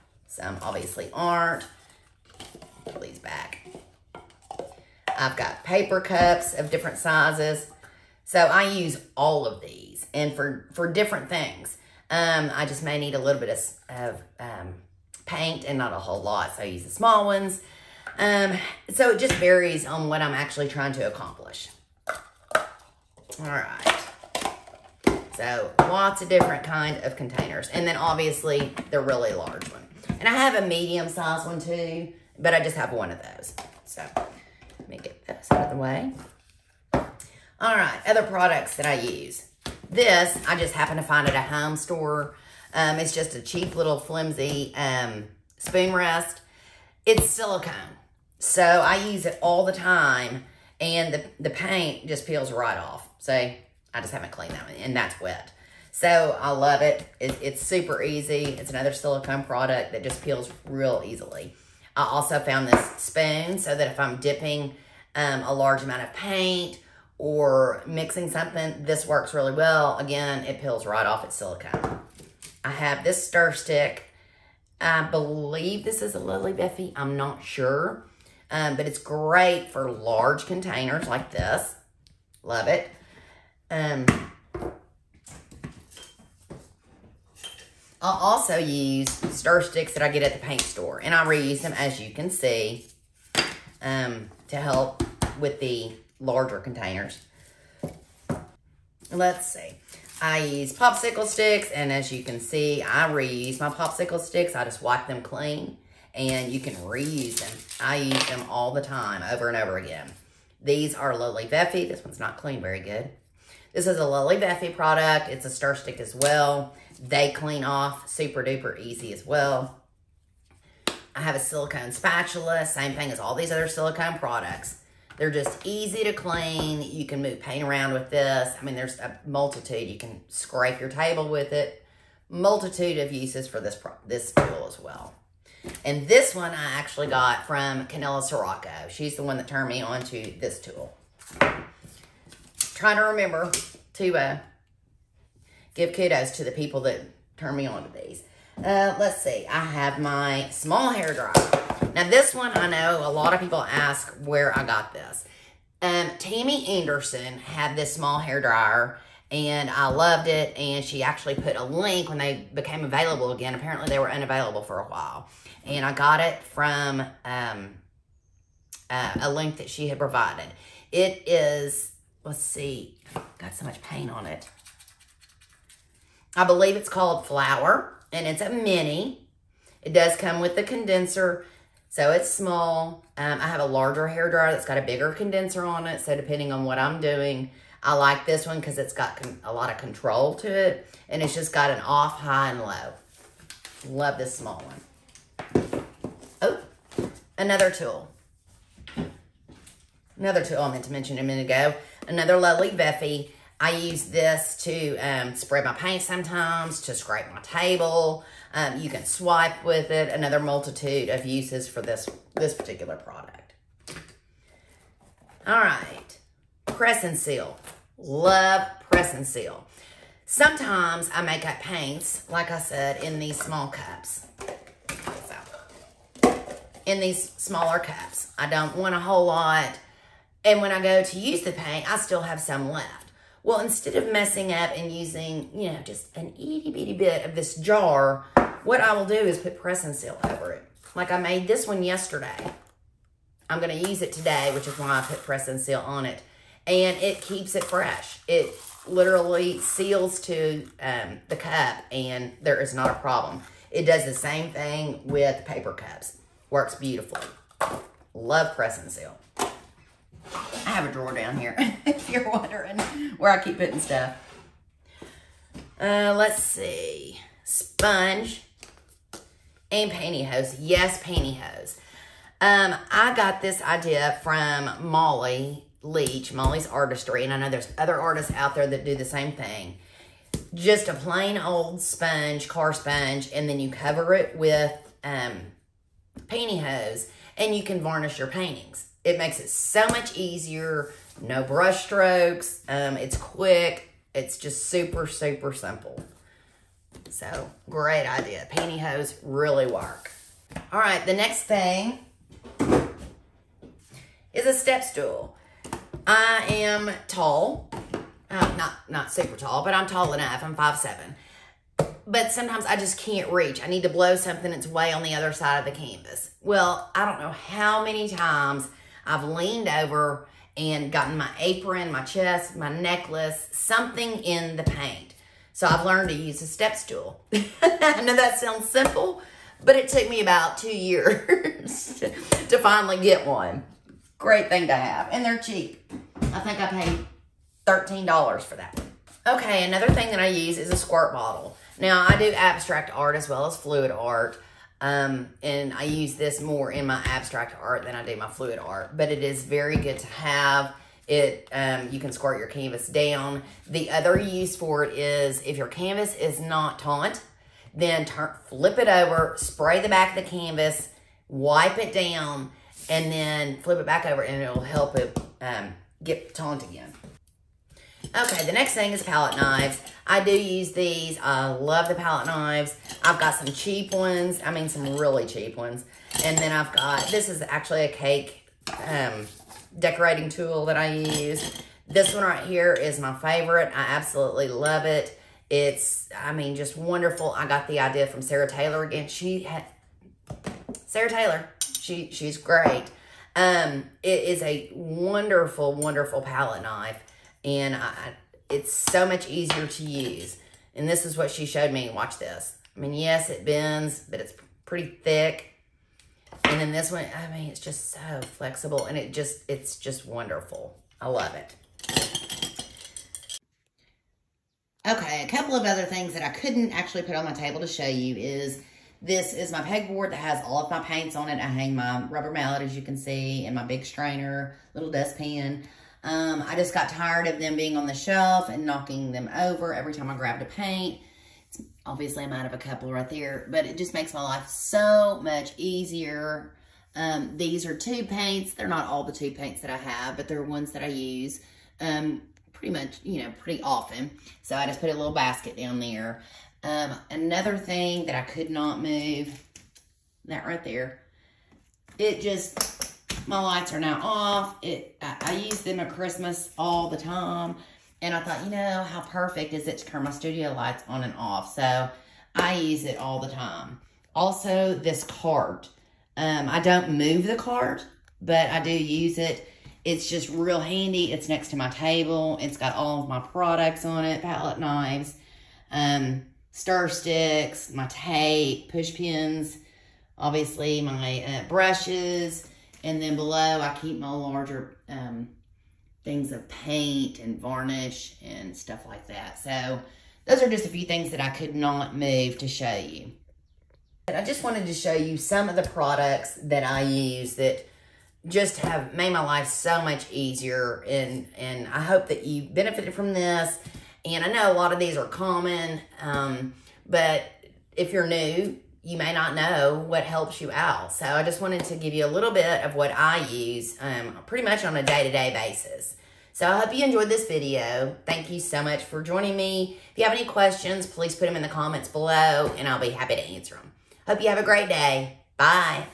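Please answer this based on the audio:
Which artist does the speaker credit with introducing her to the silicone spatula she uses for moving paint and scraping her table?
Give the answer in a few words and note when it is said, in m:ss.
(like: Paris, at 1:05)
Canela Sirocco, at 2:17.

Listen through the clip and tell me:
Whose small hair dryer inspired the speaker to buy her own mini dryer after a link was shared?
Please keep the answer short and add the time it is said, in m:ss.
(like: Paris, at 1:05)
Tammy Anderson, at 2:36.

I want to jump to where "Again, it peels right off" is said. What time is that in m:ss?
1:09.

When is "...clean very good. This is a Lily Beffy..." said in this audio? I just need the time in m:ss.
1:52.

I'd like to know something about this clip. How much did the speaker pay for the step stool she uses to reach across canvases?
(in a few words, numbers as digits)
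$13.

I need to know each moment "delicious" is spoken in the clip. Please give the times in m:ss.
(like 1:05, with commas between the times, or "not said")
not said.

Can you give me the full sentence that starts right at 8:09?
So those are just a few things that I could not move to show you.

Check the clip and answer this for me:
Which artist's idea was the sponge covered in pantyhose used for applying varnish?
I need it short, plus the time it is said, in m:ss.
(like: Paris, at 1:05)
Molly Leach, at 4:34.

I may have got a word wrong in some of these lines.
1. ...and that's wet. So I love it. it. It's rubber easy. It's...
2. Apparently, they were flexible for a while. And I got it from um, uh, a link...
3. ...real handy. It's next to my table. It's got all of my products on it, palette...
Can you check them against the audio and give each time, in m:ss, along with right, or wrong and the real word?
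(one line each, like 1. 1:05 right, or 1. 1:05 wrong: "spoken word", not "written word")
1. 0:54 wrong: "super", not "rubber"
2. 2:43 wrong: "unavailable", not "flexible"
3. 7:50 right.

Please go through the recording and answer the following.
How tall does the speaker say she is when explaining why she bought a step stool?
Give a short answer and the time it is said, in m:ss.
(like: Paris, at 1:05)
5'7", at 5:10.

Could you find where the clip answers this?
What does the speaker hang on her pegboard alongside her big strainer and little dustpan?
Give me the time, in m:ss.
7:02.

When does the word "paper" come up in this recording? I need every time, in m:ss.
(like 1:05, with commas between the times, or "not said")
0:05, 4:15.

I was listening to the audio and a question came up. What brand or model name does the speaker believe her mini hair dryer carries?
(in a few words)
Flower.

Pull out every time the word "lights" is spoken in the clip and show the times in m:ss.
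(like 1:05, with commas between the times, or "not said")
7:33, 7:40.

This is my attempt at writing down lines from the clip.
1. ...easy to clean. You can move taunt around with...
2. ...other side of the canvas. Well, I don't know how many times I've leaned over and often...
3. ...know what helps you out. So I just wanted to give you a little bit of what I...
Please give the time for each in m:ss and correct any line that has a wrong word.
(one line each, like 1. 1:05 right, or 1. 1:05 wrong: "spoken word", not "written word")
1. 2:05 wrong: "paint", not "taunt"
2. 5:15 wrong: "gotten", not "often"
3. 8:29 right.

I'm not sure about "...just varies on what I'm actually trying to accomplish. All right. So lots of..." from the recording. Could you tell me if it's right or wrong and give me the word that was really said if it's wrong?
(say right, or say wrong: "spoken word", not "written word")
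right.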